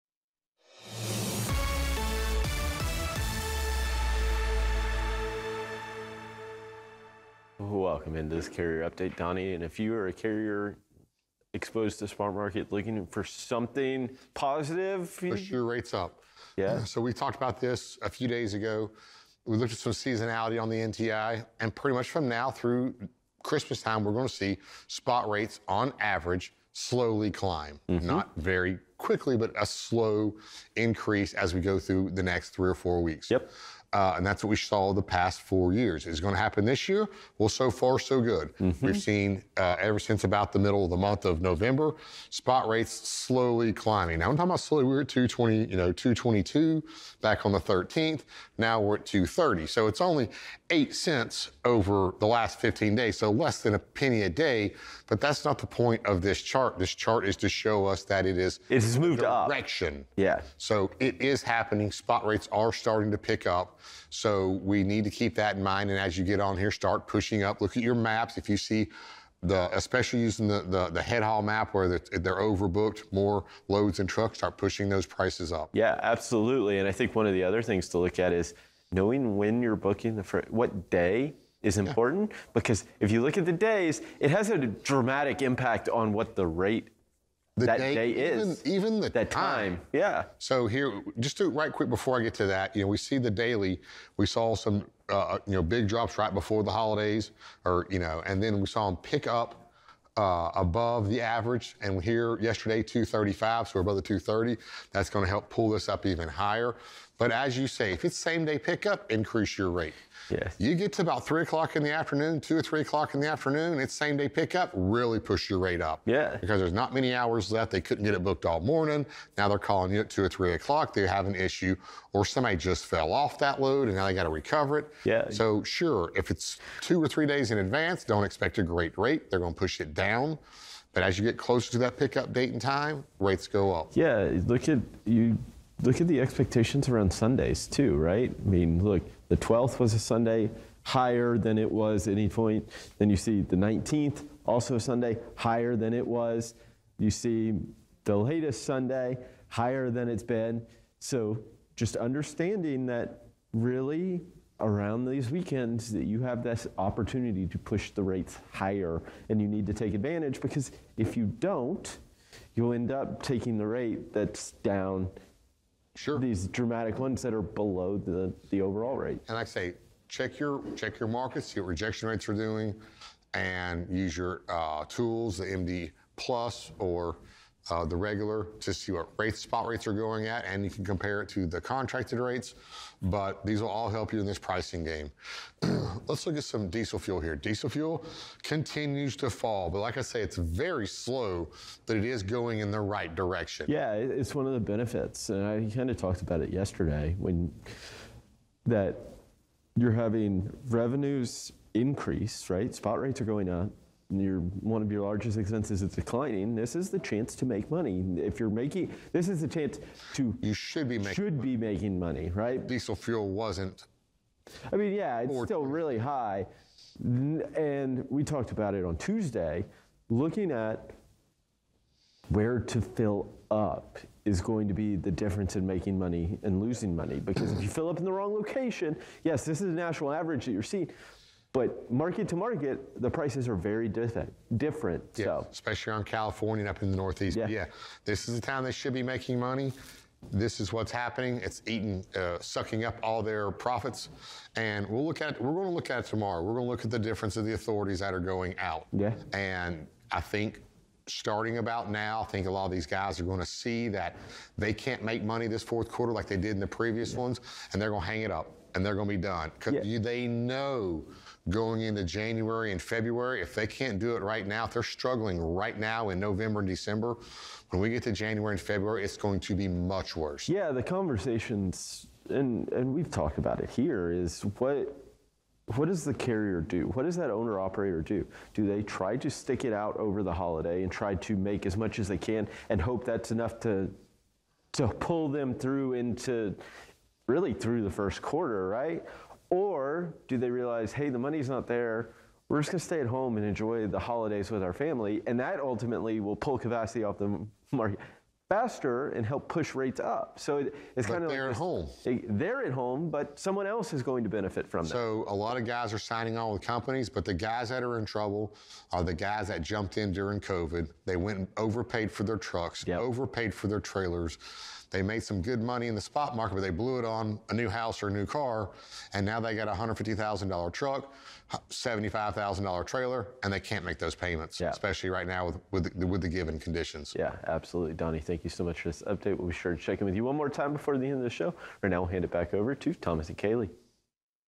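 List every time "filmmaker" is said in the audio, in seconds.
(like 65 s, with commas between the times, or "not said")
not said.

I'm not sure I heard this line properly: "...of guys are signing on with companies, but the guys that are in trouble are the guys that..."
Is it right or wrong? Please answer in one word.
right.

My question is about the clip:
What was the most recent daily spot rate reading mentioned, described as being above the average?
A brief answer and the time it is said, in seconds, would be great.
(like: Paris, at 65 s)
235, at 102 s.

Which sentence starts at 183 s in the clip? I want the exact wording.
But these will all help you in this pricing game.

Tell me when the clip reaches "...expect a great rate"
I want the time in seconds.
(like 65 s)
128 s.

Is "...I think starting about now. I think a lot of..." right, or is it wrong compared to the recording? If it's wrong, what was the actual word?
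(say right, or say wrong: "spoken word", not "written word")
right.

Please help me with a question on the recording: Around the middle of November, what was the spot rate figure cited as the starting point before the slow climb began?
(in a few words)
222.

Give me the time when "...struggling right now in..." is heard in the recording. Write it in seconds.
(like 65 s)
264 s.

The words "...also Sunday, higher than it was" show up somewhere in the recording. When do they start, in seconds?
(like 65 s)
144 s.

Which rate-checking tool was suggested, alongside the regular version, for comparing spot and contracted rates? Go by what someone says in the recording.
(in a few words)
MD Plus.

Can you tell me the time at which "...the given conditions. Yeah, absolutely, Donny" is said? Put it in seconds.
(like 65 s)
326 s.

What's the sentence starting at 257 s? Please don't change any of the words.
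ones, and they're going to hang it up and they're going to be done because yeah.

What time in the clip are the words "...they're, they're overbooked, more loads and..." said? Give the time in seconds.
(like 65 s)
71 s.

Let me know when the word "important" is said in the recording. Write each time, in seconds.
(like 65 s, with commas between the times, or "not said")
81 s.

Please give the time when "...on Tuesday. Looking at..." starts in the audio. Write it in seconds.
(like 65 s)
218 s.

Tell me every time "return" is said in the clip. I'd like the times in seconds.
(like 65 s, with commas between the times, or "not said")
not said.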